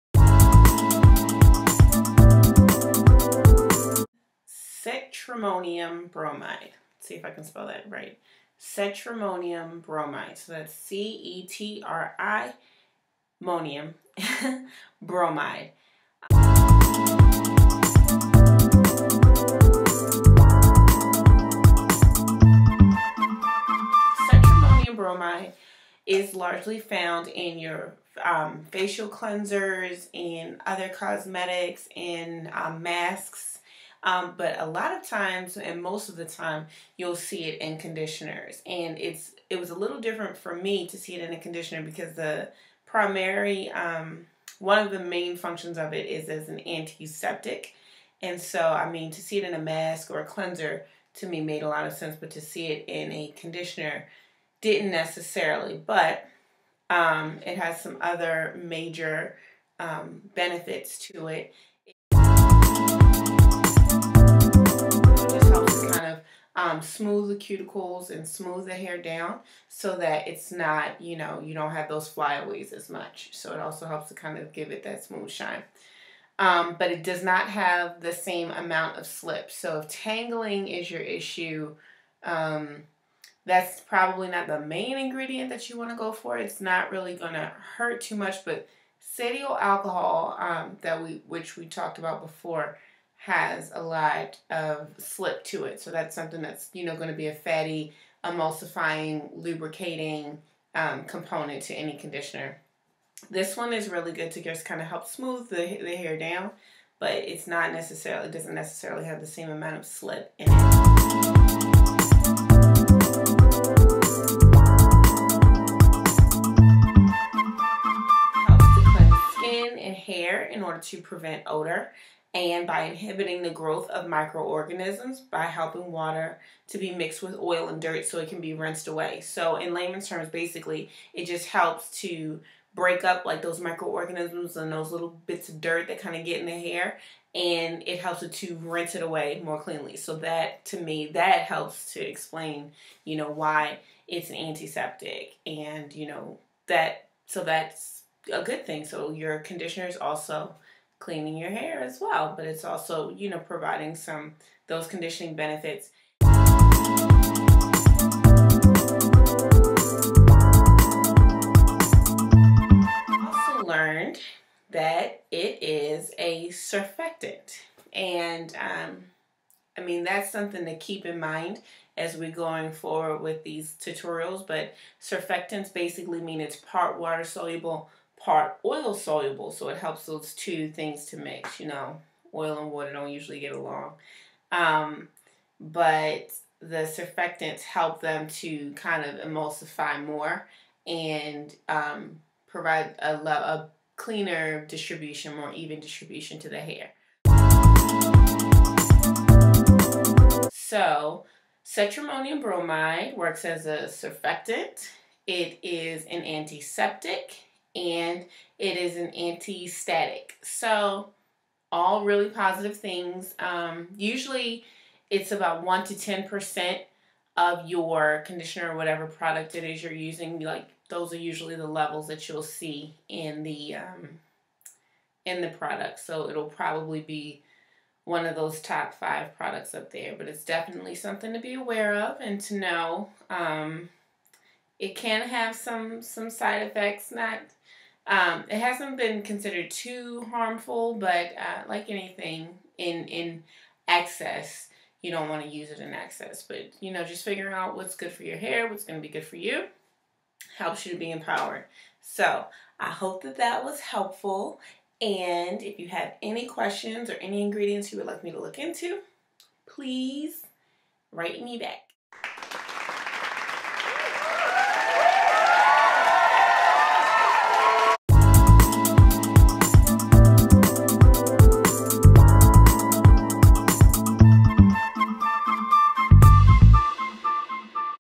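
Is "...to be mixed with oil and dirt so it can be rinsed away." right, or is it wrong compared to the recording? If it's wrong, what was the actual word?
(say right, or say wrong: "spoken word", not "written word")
right.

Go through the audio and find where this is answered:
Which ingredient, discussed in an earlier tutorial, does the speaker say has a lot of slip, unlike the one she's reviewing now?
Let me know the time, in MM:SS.
01:29.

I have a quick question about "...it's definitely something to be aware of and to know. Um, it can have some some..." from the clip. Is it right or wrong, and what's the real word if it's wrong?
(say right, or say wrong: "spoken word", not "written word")
right.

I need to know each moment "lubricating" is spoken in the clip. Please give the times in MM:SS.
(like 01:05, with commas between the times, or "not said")
01:39.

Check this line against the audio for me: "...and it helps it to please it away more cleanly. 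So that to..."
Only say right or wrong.
wrong.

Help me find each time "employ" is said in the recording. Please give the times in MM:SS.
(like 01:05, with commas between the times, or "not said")
not said.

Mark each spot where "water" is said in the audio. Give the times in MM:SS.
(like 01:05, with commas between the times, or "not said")
02:05, 02:56, 03:02.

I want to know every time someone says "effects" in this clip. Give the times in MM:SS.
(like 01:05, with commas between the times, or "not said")
03:56.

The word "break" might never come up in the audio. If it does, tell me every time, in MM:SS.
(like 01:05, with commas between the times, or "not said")
02:12.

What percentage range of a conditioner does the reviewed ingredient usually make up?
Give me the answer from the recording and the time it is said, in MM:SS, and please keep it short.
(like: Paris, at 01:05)
1 to 10%, at 03:35.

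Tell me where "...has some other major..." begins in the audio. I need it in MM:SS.
00:57.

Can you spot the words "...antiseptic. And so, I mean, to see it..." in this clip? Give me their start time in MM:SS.
00:46.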